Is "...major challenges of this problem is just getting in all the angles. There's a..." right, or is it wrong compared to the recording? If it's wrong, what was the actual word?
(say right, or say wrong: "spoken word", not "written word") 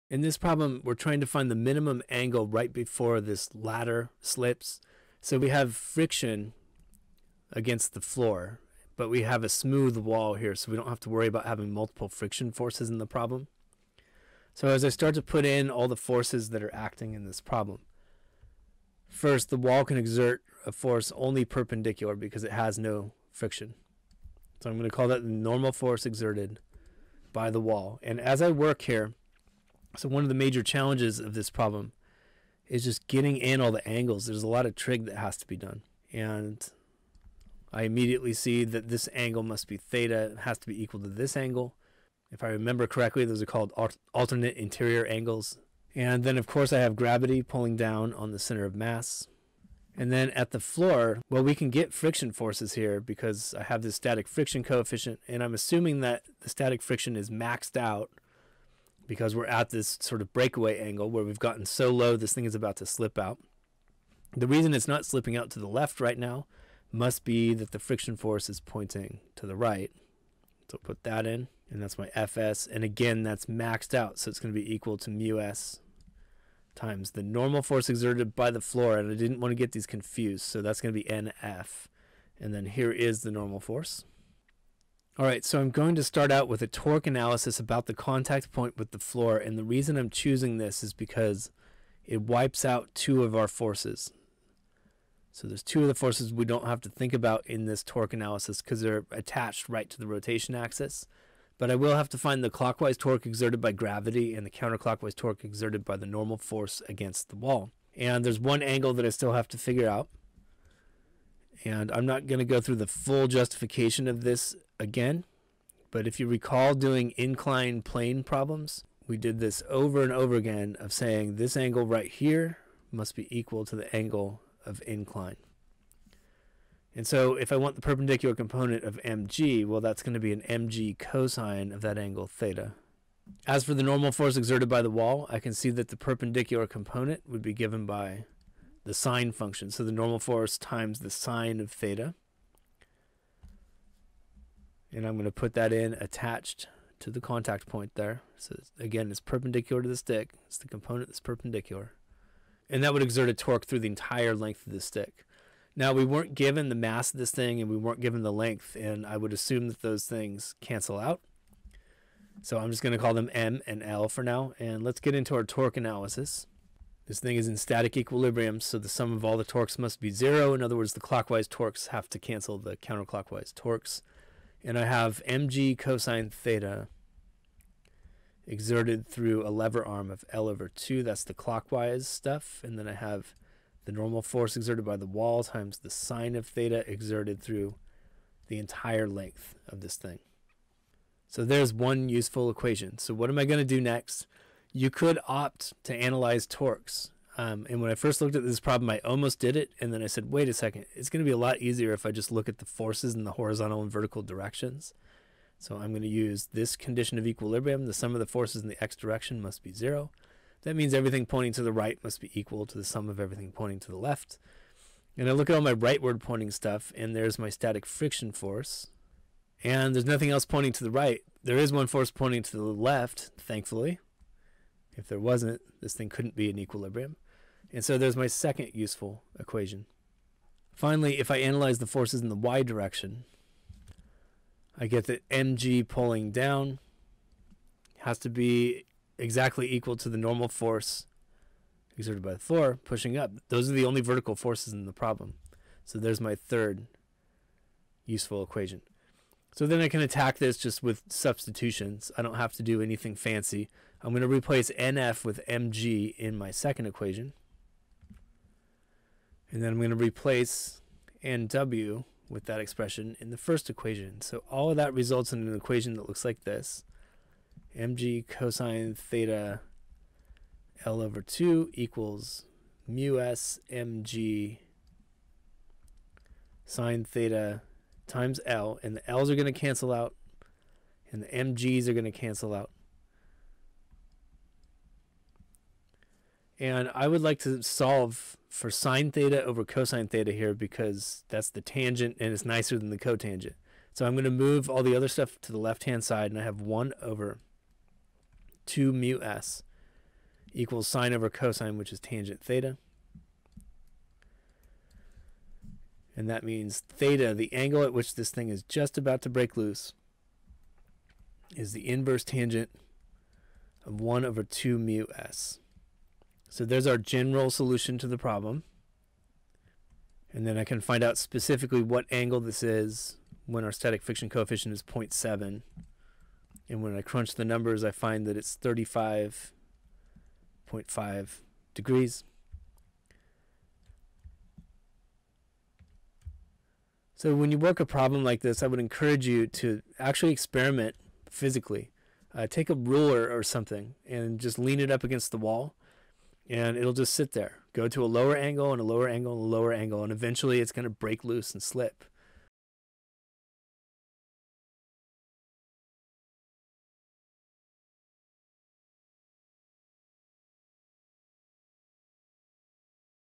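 right.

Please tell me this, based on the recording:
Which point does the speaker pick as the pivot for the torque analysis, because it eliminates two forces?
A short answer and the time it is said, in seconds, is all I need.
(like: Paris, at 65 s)
contact point with the floor, at 87 s.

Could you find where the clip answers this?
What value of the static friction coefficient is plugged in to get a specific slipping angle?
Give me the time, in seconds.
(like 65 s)
324 s.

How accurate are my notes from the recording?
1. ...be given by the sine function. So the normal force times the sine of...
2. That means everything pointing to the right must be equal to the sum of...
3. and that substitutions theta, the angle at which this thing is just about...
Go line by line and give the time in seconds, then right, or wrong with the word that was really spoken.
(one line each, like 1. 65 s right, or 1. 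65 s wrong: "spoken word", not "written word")
1. 137 s right
2. 210 s right
3. 306 s wrong: "means", not "substitutions".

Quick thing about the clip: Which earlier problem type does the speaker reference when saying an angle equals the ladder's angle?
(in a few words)
incline plane problems.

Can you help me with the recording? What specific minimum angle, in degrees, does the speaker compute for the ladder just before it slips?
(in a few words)
35.5 degrees.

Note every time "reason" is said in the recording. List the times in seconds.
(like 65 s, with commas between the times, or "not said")
64 s, 89 s.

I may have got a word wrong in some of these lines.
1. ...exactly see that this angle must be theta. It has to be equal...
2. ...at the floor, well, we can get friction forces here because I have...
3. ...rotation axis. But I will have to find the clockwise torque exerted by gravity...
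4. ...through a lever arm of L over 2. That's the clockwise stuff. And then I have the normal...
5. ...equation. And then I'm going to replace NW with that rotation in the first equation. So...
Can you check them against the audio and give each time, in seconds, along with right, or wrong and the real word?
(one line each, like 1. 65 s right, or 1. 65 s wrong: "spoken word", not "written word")
1. 37 s wrong: "immediately", not "exactly"
2. 50 s right
3. 100 s right
4. 179 s right
5. 256 s wrong: "expression", not "rotation".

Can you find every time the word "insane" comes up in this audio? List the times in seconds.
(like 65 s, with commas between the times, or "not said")
not said.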